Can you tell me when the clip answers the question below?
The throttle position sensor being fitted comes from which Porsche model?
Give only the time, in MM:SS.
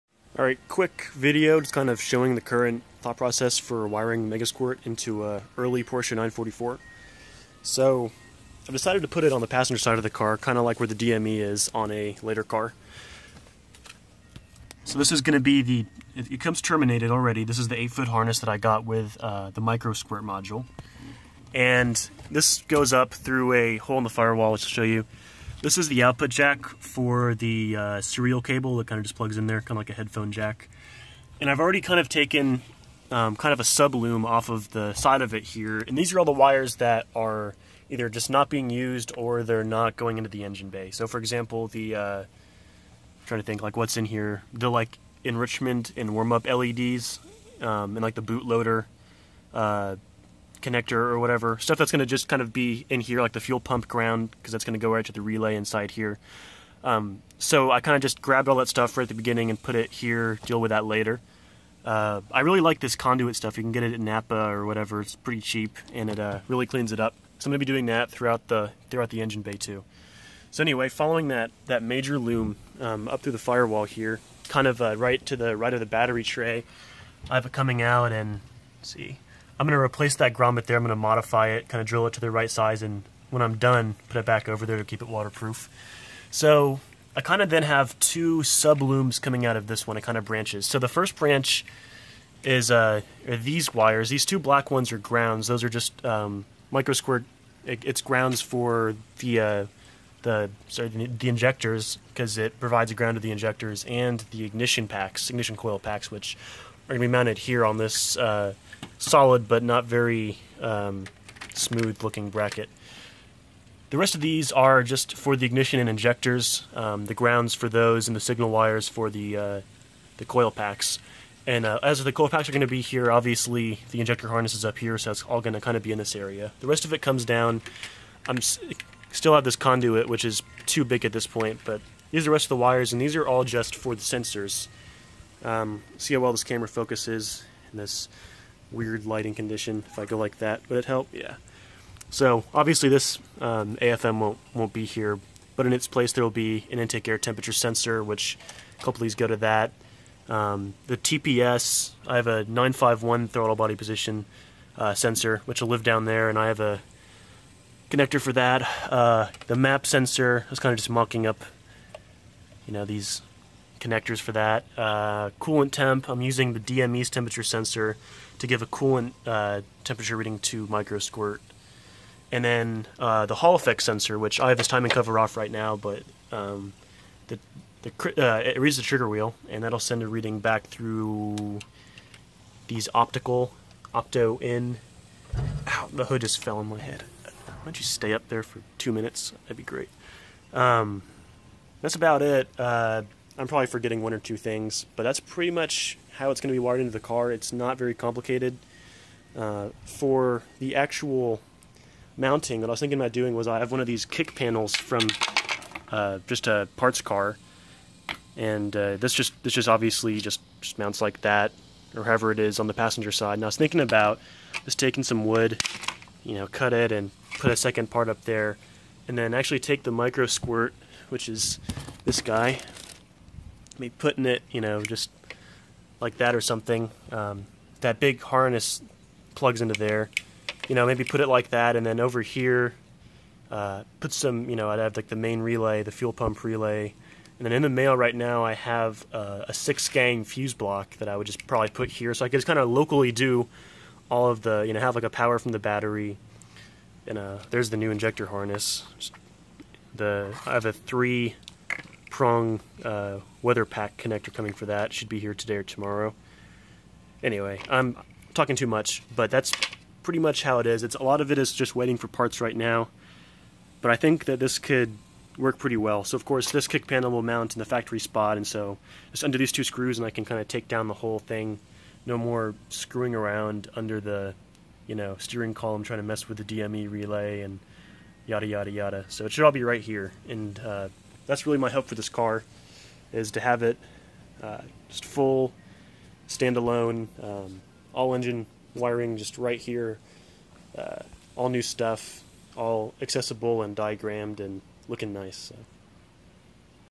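02:32.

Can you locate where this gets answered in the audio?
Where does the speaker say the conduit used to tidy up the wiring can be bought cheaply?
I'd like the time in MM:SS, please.
01:03.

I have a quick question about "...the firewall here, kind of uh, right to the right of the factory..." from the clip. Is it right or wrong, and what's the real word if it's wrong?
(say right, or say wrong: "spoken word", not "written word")
wrong: "battery", not "factory".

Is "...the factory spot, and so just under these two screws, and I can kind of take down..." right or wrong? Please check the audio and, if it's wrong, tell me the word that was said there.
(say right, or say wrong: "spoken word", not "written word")
right.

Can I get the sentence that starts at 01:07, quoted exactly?
So I'm going to be doing that throughout the throughout the engine bay too.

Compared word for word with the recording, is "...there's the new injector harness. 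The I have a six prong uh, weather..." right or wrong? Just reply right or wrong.
wrong.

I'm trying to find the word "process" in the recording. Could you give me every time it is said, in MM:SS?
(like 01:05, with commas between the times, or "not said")
00:03.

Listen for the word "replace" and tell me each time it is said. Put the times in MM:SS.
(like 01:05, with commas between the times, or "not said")
01:19.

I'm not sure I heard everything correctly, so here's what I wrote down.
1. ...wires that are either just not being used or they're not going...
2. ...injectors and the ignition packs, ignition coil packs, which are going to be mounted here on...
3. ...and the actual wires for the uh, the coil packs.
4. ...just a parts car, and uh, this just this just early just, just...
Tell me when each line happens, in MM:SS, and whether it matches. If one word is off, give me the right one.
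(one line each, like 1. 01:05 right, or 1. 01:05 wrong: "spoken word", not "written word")
1. 00:36 right
2. 01:43 right
3. 01:58 wrong: "signal", not "actual"
4. 03:26 wrong: "obviously", not "early".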